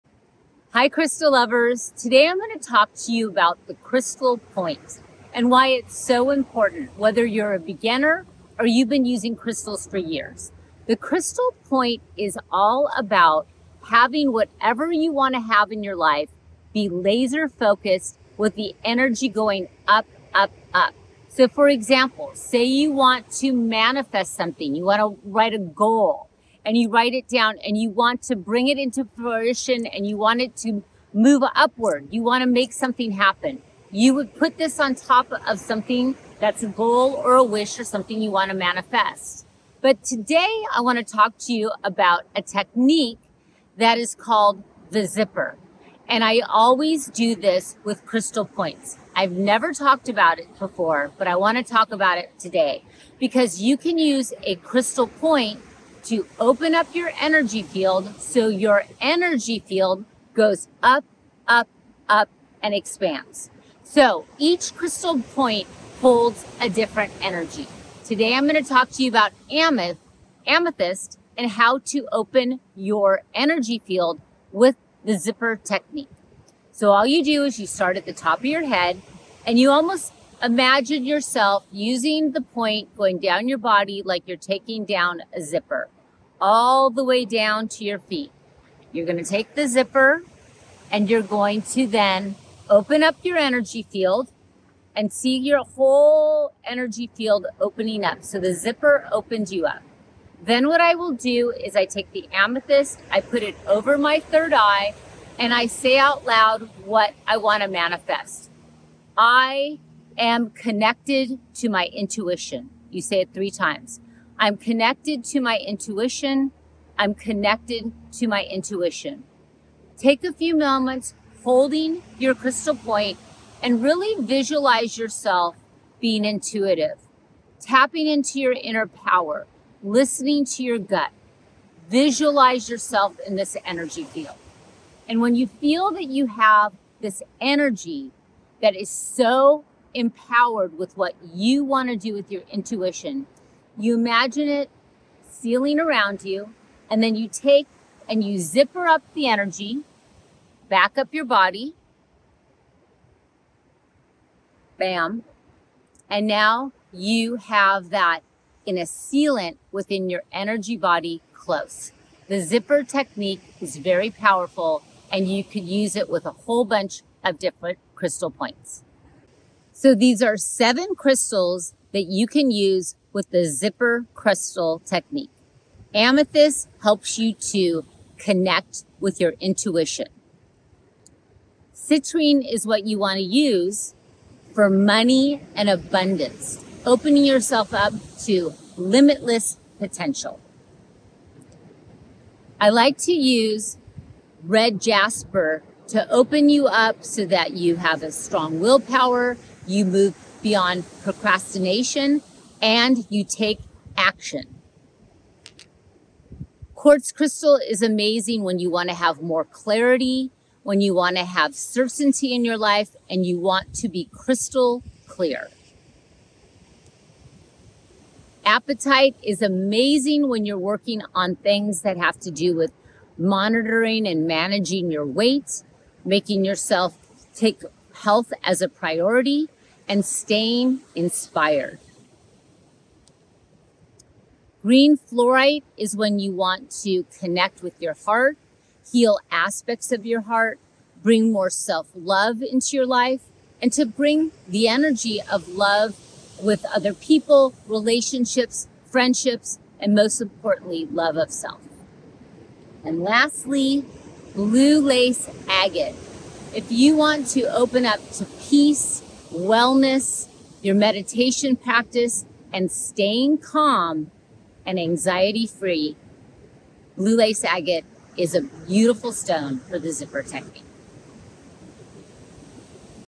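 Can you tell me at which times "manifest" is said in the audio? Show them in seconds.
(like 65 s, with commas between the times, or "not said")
23 s, 38 s, 107 s.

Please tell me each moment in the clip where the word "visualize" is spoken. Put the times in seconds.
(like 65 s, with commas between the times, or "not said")
124 s, 131 s.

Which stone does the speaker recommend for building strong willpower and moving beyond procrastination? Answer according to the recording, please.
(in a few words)
red jasper.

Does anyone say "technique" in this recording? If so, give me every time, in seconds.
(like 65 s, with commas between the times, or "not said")
42 s, 75 s, 162 s, 174 s, 270 s.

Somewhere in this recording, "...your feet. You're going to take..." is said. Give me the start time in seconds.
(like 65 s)
87 s.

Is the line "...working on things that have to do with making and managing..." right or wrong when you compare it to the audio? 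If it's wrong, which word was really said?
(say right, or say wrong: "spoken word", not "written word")
wrong: "monitoring", not "making".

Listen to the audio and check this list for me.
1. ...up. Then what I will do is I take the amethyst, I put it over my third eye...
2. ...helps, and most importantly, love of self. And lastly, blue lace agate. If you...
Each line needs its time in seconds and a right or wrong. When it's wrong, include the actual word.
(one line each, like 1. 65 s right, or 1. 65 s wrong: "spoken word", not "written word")
1. 99 s right
2. 248 s wrong: "friendships", not "helps".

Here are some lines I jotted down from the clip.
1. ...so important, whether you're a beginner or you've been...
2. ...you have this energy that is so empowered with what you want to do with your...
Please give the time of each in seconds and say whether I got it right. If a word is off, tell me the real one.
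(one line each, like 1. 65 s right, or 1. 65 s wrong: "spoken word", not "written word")
1. 5 s right
2. 136 s right.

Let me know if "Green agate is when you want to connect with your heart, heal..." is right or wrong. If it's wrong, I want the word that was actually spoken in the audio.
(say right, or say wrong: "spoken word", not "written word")
wrong: "fluorite", not "agate".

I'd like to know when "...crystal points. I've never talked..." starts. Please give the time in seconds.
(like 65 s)
48 s.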